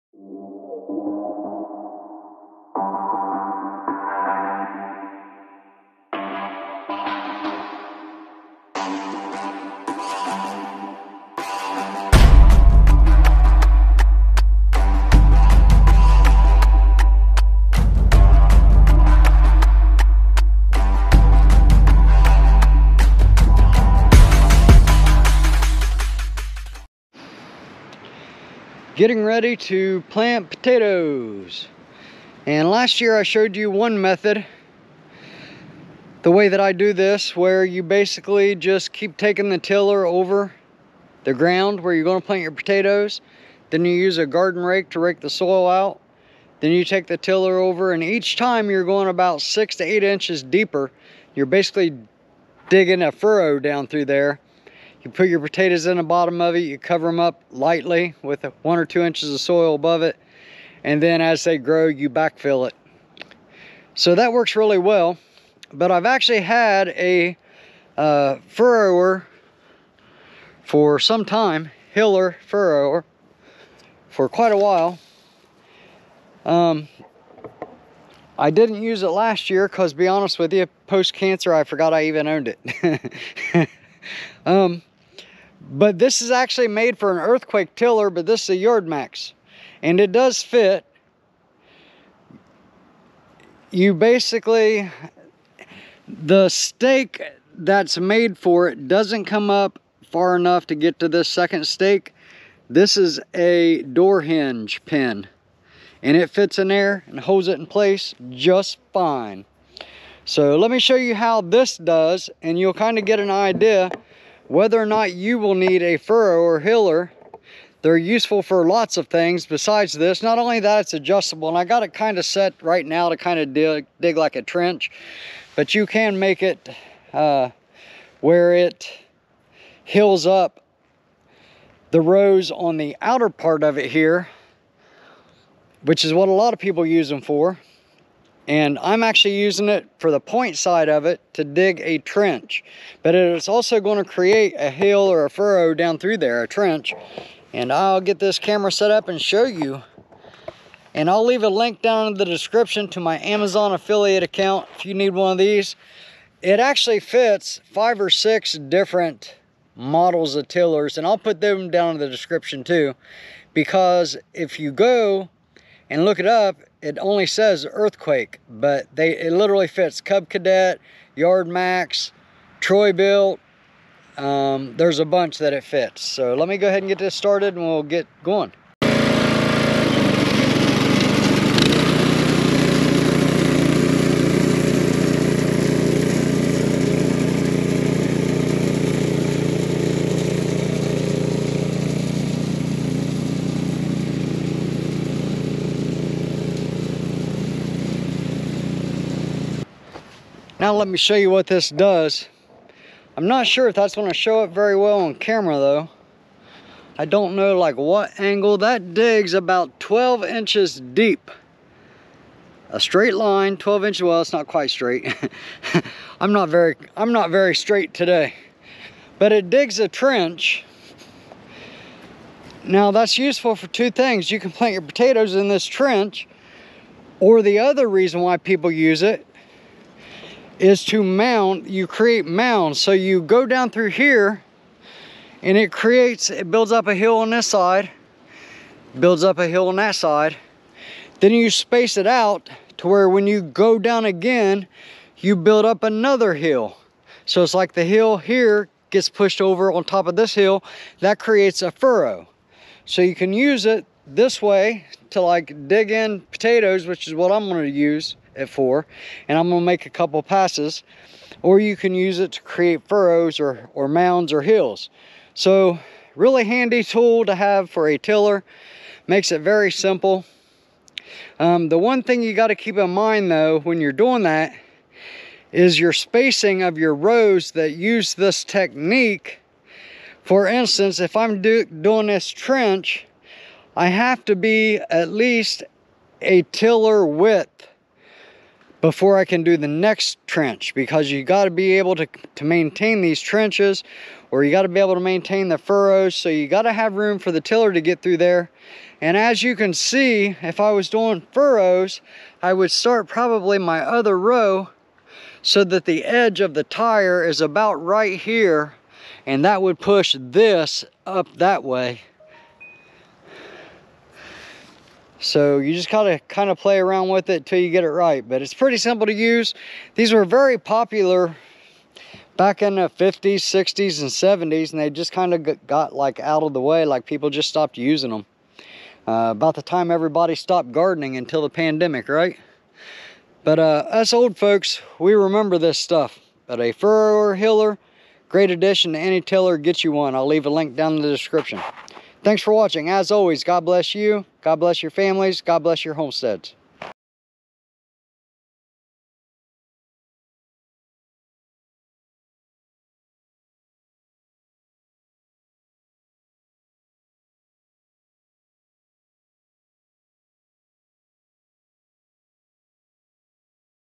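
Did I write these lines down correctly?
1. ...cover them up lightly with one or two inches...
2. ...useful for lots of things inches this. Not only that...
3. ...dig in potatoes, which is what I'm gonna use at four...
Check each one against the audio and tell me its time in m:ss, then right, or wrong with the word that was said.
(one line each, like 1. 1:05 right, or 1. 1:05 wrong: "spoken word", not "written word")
1. 0:56 right
2. 1:57 wrong: "besides", not "inches"
3. 4:15 right.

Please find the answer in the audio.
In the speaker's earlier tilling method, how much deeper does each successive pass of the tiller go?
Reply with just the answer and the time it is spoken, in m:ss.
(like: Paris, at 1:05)
6 to 8 inches, at 0:49.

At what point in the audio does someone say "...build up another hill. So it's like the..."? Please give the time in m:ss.
4:05.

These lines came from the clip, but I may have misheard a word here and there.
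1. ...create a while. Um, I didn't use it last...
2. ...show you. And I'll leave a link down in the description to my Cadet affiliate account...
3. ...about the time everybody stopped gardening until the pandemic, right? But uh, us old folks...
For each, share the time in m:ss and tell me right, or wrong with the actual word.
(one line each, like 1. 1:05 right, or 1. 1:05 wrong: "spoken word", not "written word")
1. 1:14 wrong: "quite", not "create"
2. 2:29 wrong: "Amazon", not "Cadet"
3. 5:29 right.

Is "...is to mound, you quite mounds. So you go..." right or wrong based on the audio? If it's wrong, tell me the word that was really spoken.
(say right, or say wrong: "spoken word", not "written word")
wrong: "create", not "quite".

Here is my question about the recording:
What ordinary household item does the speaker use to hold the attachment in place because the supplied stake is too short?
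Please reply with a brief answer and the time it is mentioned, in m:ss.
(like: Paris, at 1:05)
door hinge pin, at 1:43.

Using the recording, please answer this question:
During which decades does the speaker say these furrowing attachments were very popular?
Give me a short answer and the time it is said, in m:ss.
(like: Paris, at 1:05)
50s, 60s, and 70s, at 5:22.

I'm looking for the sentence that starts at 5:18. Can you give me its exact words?
But it's pretty simple to use.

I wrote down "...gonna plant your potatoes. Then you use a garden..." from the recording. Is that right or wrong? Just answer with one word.
right.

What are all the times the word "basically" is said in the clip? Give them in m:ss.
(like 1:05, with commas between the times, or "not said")
0:37, 0:51, 1:33.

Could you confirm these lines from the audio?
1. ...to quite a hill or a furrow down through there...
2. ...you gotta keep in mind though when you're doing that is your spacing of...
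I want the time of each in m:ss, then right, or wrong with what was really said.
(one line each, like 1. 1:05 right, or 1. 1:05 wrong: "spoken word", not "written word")
1. 2:24 wrong: "create", not "quite"
2. 4:32 right.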